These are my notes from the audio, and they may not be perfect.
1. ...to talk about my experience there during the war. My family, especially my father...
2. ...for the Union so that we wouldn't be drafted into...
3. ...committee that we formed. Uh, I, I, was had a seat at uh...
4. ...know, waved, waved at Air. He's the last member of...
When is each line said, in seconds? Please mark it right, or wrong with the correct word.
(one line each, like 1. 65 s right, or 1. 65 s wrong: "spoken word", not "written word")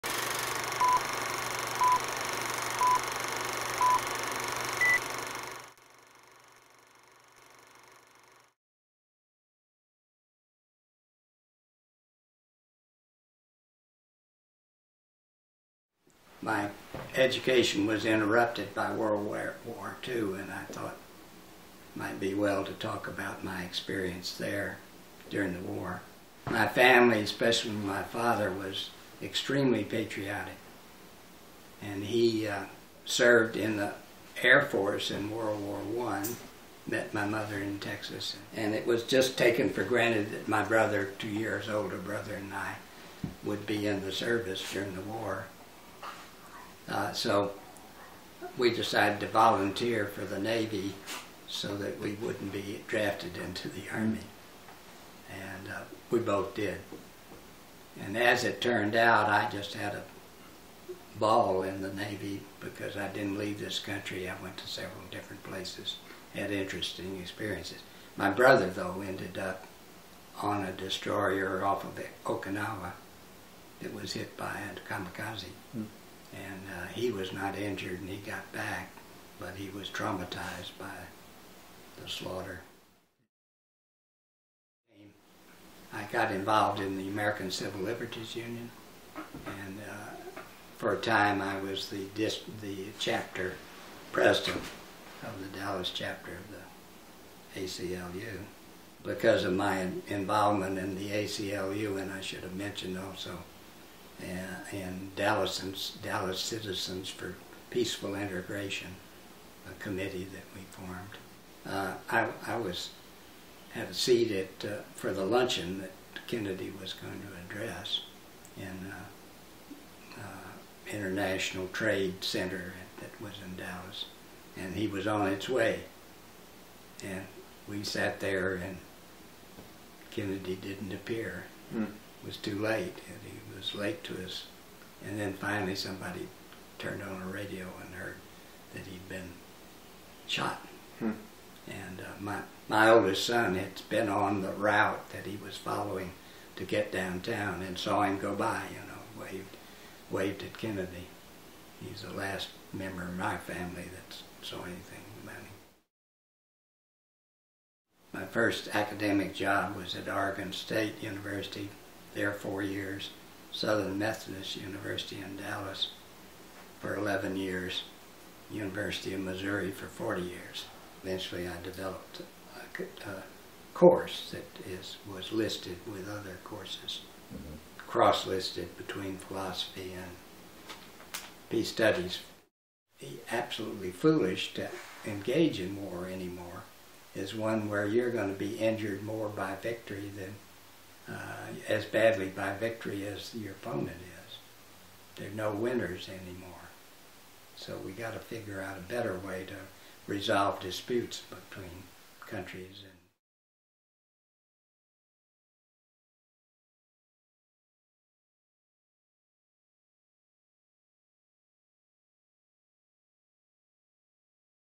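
1. 22 s right
2. 50 s wrong: "Navy", not "Union"
3. 109 s right
4. 148 s wrong: "Kennedy", not "Air".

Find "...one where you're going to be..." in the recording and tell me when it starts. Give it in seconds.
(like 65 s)
187 s.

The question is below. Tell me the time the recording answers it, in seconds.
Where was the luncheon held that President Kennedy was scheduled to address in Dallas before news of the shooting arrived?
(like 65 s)
120 s.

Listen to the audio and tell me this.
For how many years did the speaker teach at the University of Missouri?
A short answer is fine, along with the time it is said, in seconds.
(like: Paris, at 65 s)
40 years, at 169 s.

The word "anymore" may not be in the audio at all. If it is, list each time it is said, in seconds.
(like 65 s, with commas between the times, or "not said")
186 s, 196 s.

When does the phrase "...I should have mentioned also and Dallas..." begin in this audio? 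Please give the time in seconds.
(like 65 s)
102 s.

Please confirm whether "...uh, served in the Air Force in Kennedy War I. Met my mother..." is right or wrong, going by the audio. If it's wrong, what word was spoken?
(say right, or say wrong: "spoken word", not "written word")
wrong: "World", not "Kennedy".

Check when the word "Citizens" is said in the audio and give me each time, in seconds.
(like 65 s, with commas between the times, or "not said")
106 s.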